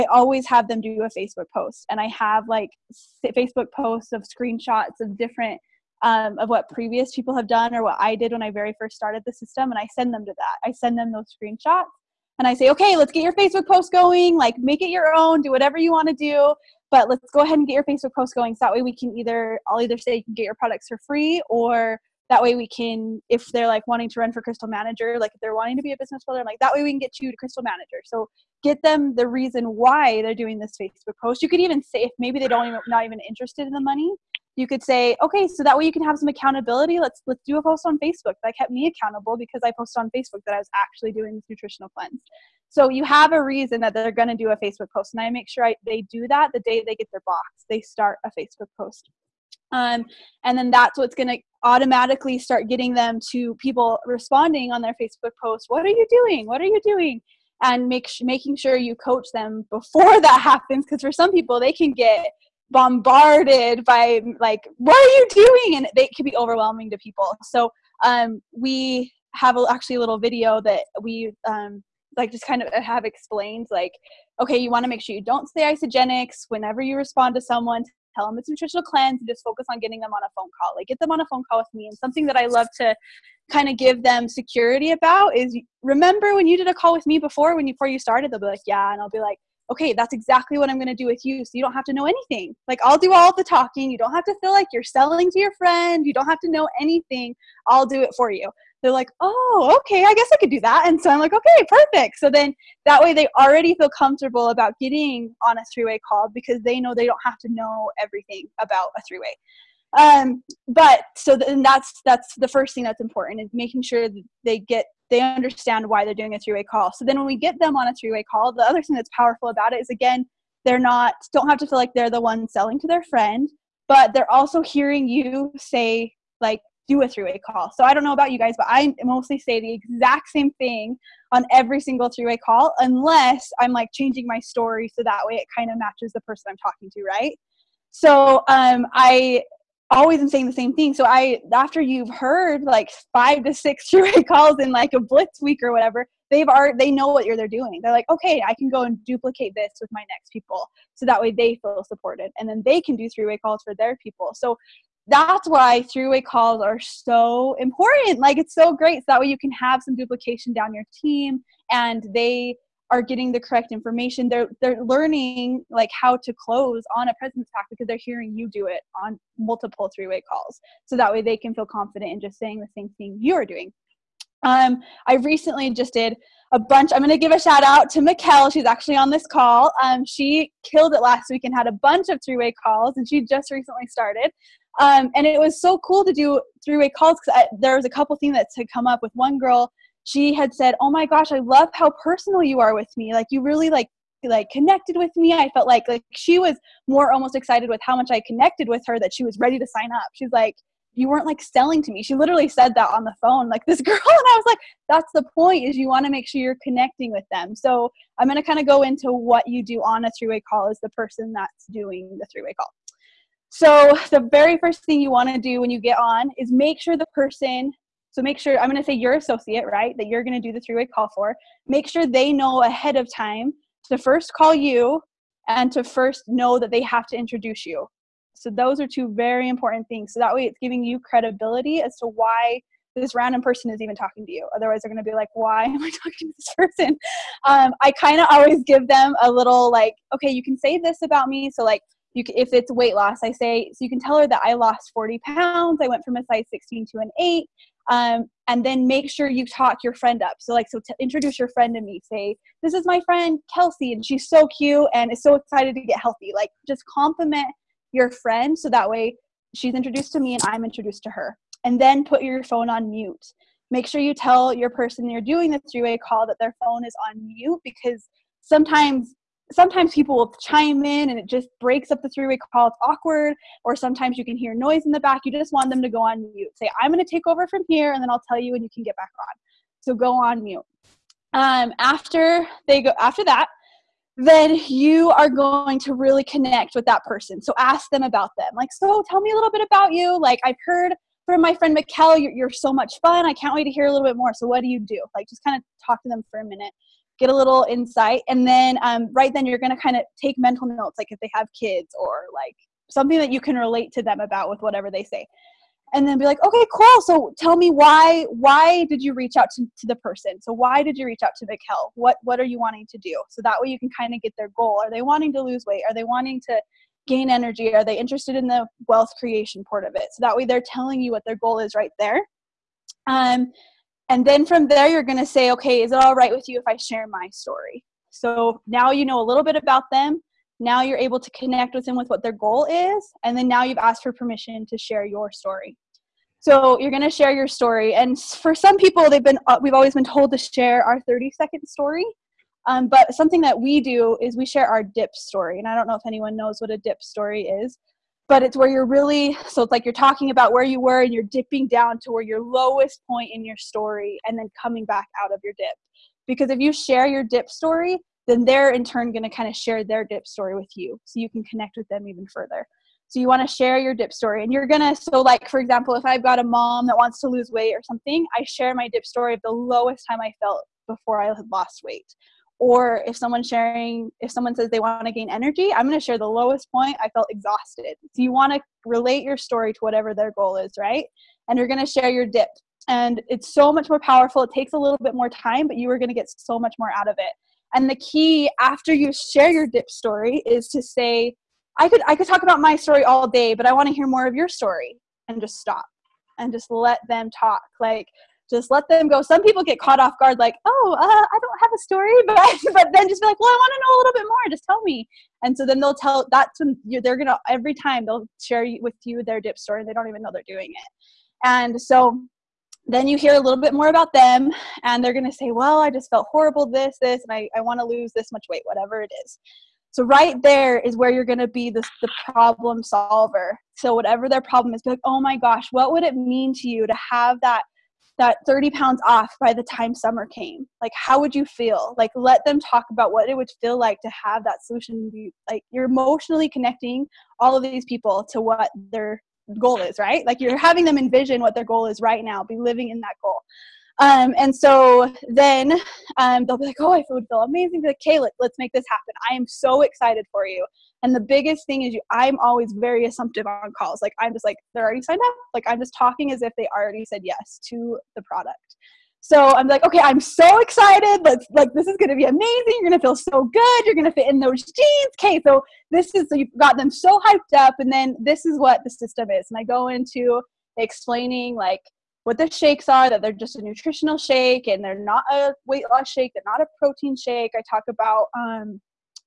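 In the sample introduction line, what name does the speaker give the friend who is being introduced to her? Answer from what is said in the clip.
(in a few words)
Kelsey.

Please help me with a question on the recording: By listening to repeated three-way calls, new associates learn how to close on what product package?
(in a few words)
presence pack.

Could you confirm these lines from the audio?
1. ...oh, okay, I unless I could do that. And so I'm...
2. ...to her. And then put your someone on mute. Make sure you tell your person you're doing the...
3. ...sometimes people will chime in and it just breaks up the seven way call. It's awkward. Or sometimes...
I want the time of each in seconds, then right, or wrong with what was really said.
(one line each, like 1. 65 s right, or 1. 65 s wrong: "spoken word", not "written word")
1. 99 s wrong: "guess", not "unless"
2. 261 s wrong: "phone", not "someone"
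3. 269 s wrong: "three", not "seven".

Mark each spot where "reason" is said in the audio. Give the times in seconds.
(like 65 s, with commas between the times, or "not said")
29 s, 43 s.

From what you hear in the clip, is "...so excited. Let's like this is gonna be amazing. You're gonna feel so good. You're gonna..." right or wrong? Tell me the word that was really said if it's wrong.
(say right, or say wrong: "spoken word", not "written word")
right.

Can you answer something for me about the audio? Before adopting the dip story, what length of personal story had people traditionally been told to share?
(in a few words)
30 second.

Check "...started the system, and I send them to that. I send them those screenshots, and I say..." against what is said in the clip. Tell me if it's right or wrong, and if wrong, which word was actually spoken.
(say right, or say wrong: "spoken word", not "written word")
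right.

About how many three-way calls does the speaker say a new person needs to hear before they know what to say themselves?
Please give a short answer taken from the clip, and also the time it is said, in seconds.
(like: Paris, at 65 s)
5 to 6, at 143 s.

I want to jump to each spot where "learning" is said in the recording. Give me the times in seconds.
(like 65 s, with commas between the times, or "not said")
164 s.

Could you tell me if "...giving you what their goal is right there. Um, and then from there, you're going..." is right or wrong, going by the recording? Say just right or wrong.
wrong.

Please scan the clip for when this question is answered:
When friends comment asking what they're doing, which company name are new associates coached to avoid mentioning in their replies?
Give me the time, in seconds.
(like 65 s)
75 s.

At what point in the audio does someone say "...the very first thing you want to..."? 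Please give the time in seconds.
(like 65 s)
214 s.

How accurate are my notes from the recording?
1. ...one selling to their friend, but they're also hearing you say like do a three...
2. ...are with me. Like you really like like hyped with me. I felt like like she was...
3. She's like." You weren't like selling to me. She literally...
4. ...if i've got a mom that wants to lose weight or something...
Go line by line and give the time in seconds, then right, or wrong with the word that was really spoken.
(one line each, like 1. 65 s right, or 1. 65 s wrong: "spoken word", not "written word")
1. 122 s right
2. 192 s wrong: "connected", not "hyped"
3. 200 s right
4. 365 s right.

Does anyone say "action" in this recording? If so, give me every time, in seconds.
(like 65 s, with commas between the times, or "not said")
not said.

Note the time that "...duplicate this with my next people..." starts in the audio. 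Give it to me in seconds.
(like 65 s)
149 s.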